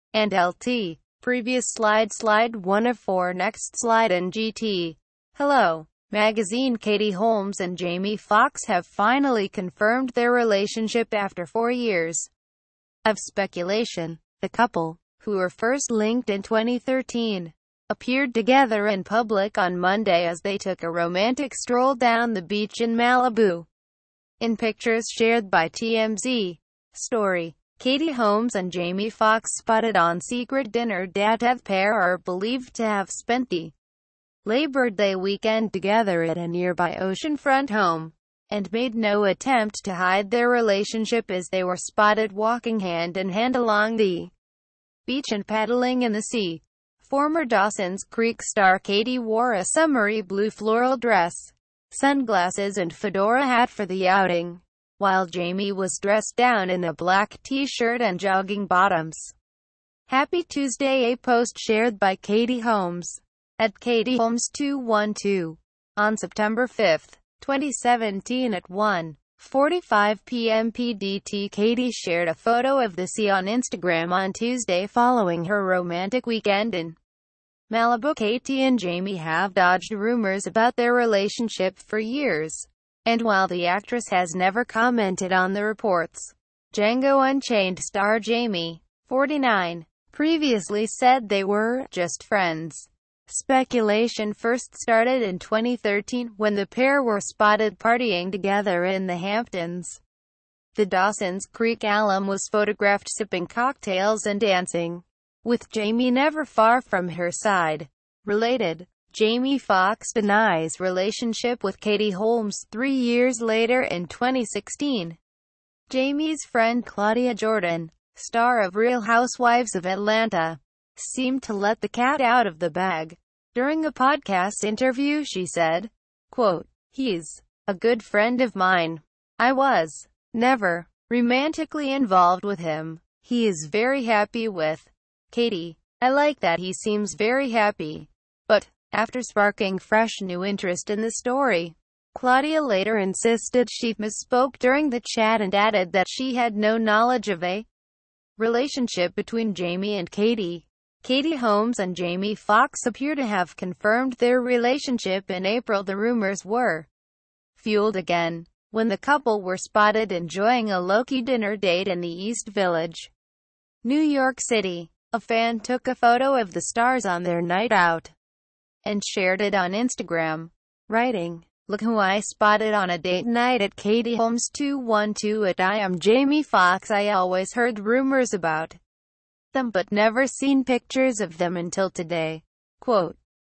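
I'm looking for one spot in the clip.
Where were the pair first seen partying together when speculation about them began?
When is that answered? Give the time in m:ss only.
1:39.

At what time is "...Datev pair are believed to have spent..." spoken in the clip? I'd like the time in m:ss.
0:31.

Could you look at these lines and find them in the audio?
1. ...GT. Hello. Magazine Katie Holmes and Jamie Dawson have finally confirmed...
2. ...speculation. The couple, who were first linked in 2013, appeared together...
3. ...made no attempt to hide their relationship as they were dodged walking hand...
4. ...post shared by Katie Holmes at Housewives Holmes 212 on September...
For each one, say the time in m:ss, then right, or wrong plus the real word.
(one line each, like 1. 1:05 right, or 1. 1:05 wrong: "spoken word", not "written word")
1. 0:04 wrong: "Foxx", not "Dawson"
2. 0:13 right
3. 0:38 wrong: "spotted", not "dodged"
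4. 1:01 wrong: "Katie", not "Housewives".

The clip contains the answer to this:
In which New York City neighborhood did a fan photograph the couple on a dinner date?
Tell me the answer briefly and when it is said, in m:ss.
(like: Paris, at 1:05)
East Village, at 2:42.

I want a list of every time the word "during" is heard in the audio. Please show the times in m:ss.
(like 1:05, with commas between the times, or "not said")
2:03, 2:24.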